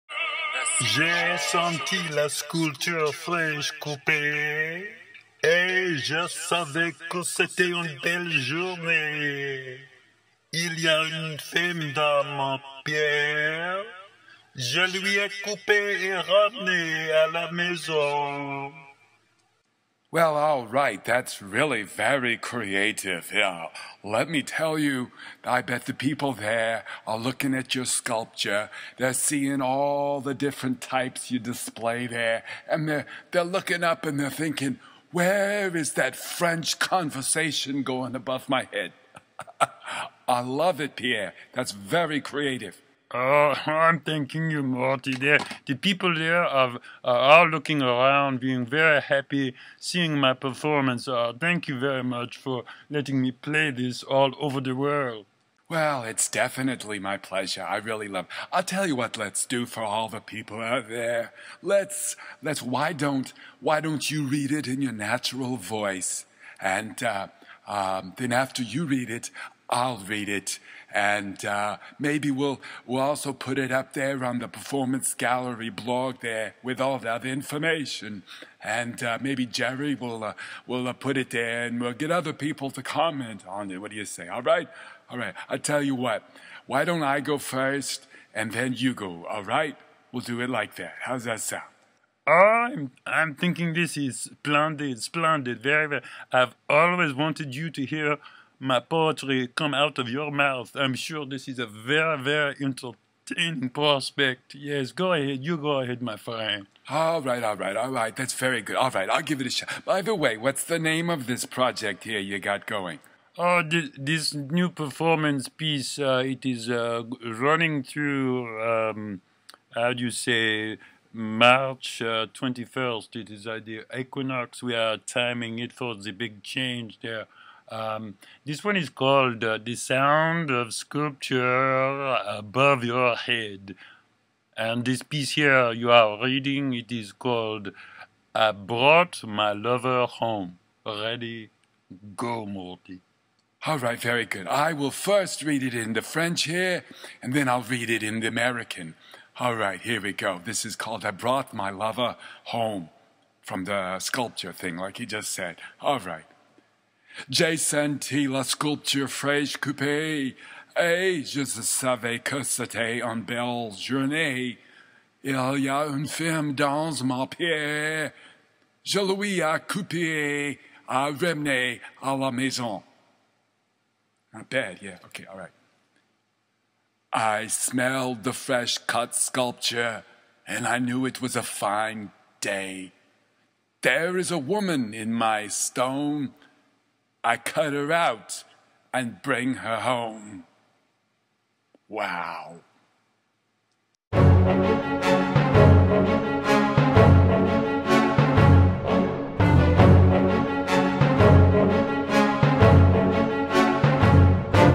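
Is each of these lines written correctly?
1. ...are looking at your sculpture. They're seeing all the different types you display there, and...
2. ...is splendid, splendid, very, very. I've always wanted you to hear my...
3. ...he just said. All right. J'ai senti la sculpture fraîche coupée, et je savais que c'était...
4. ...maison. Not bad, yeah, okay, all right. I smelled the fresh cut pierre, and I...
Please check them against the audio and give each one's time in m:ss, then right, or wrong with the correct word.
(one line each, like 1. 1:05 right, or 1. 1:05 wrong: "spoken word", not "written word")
1. 0:27 right
2. 1:33 right
3. 2:34 right
4. 2:52 wrong: "sculpture", not "pierre".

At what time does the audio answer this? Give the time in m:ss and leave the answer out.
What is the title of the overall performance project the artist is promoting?
2:09.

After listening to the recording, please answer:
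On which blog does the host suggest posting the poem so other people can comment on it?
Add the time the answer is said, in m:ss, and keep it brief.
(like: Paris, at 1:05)
Performance Gallery blog, at 1:14.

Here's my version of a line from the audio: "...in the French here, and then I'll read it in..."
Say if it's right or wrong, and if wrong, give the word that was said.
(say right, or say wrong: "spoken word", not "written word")
right.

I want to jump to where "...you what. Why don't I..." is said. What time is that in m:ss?
1:25.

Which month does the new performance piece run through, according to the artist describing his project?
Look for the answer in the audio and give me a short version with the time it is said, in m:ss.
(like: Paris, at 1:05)
March, at 2:01.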